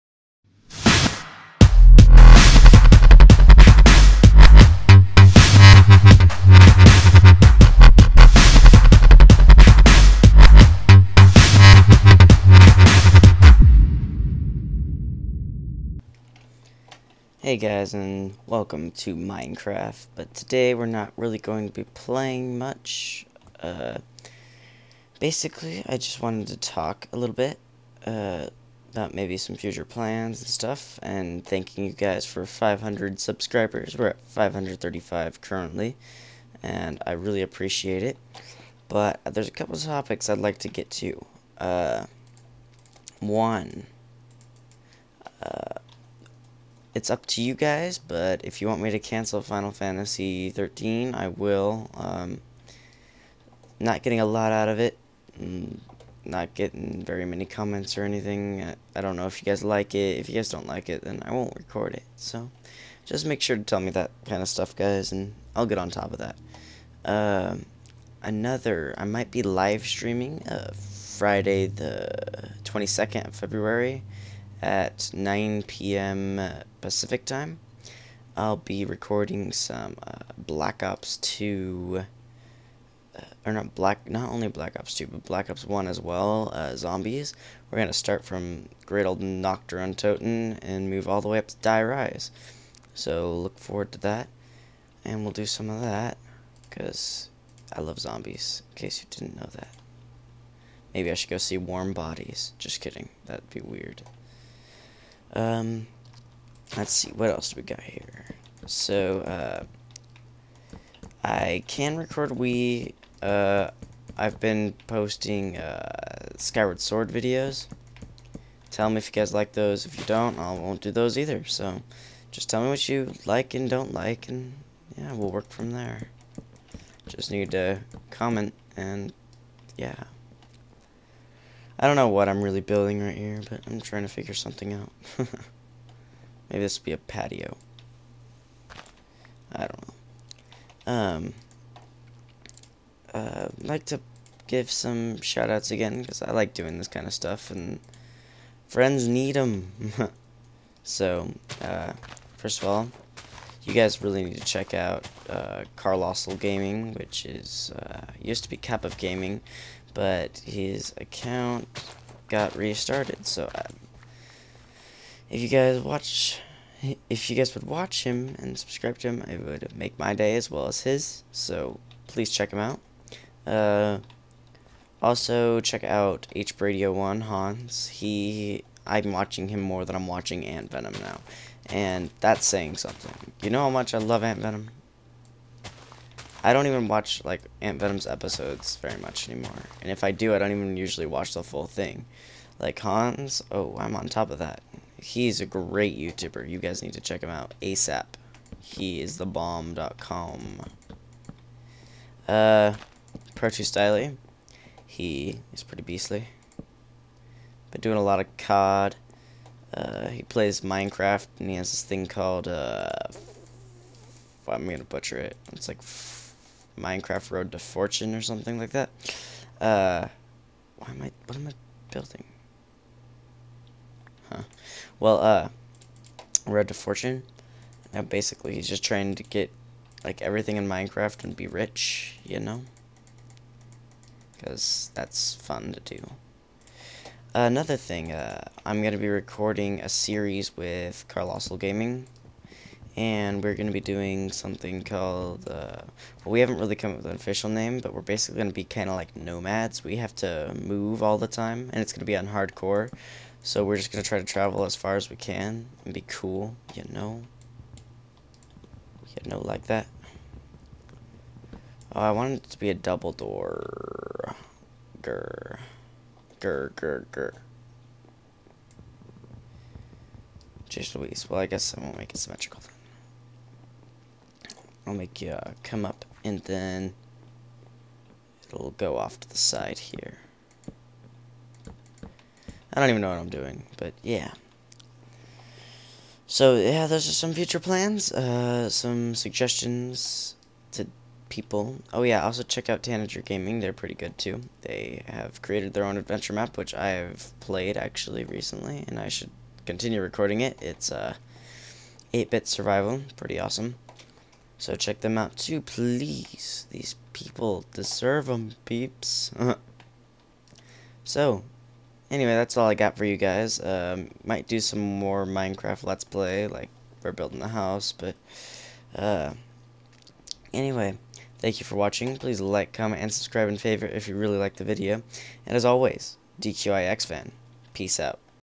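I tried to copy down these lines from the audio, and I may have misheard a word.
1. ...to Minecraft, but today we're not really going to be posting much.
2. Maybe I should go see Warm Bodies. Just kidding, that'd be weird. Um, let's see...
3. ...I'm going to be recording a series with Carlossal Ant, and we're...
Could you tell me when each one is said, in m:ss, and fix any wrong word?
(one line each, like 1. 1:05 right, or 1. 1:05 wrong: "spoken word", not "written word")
1. 0:18 wrong: "playing", not "posting"
2. 1:40 right
3. 3:58 wrong: "Gaming", not "Ant".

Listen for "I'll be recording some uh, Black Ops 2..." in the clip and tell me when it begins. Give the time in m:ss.
1:18.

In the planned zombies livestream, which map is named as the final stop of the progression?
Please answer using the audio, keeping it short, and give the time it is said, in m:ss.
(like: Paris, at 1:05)
Die Rise, at 1:31.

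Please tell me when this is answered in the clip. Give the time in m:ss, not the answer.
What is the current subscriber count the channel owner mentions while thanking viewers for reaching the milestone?
0:34.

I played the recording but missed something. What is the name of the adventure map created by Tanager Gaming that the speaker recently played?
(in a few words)
8-bit survival.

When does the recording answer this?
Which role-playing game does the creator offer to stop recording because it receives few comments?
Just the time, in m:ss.
0:49.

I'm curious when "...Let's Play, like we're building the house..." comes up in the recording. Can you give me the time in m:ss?
5:15.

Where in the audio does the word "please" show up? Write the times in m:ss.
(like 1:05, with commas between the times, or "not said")
2:52, 5:05, 5:22.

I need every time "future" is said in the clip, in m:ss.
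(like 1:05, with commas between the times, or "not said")
0:29, 4:47.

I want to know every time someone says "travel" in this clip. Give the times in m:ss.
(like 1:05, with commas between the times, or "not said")
4:14.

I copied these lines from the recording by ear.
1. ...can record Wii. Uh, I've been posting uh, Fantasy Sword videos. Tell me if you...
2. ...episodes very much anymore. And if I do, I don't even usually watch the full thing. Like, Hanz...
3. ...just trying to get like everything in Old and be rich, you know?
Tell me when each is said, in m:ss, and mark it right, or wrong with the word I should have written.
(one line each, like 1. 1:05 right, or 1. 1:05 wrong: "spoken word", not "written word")
1. 1:51 wrong: "Skyward", not "Fantasy"
2. 3:08 right
3. 3:48 wrong: "Minecraft", not "Old".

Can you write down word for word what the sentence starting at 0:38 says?
But there's a couple topics I'd like to get to.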